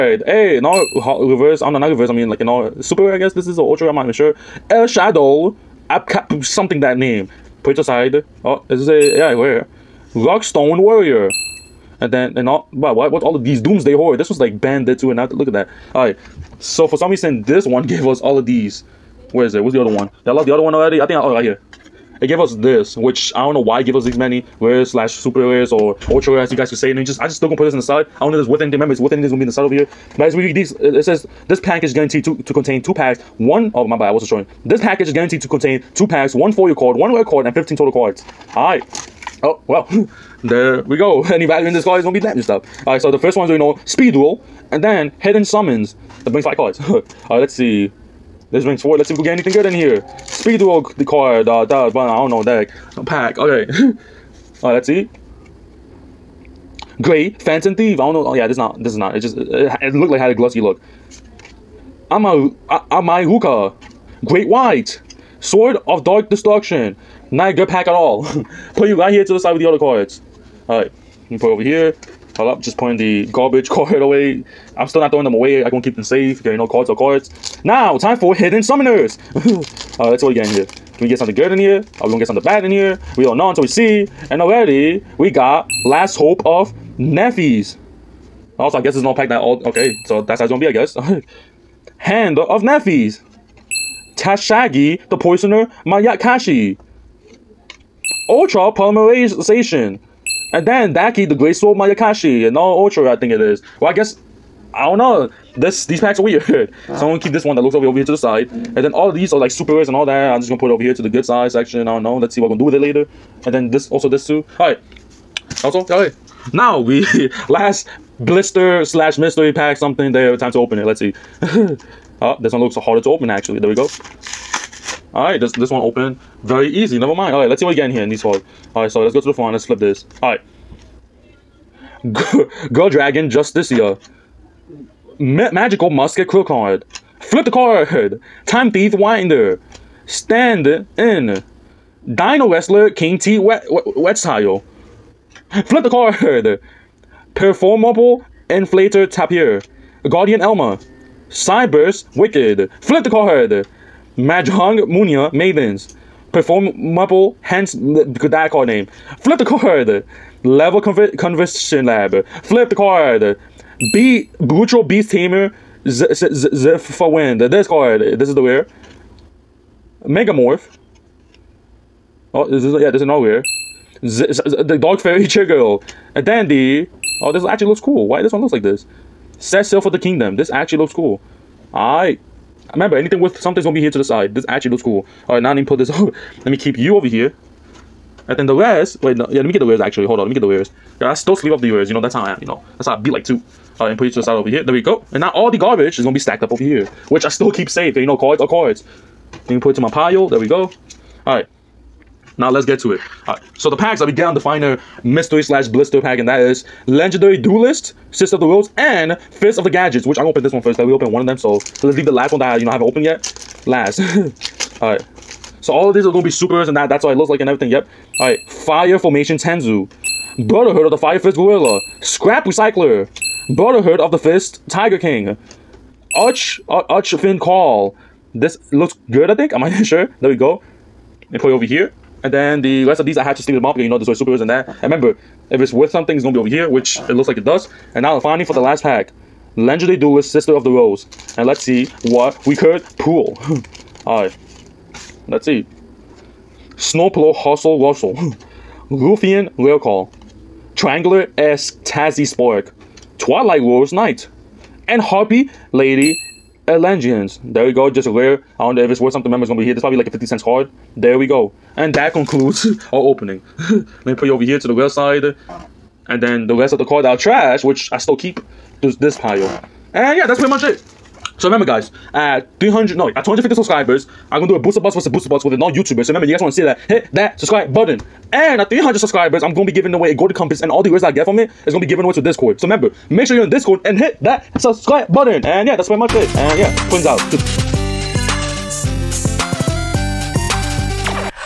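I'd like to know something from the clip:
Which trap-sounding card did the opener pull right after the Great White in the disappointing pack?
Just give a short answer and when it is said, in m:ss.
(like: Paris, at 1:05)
Sword of Dark Destruction, at 1:05.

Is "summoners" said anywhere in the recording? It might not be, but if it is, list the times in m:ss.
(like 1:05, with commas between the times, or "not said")
0:45, 1:18.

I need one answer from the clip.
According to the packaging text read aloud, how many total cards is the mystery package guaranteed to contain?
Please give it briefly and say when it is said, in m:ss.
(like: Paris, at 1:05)
15, at 0:37.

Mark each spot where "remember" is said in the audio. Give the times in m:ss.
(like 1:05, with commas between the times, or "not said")
0:28, 3:02, 3:54, 4:19, 4:31, 4:36, 4:42.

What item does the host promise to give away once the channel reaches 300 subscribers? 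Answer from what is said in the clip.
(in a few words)
a golden compass.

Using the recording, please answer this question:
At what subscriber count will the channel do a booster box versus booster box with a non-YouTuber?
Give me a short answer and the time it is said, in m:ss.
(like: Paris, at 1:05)
250, at 4:33.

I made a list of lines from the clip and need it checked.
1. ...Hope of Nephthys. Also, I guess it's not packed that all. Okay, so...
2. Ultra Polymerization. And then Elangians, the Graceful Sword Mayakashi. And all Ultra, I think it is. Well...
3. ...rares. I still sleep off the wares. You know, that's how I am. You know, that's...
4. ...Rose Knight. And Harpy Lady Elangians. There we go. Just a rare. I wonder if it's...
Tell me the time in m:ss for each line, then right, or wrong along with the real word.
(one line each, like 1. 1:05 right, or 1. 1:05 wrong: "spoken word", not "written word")
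1. 1:26 right
2. 1:38 wrong: "Dakki", not "Elangians"
3. 3:10 wrong: "wares", not "rares"
4. 4:13 right.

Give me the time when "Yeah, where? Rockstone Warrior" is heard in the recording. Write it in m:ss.
0:09.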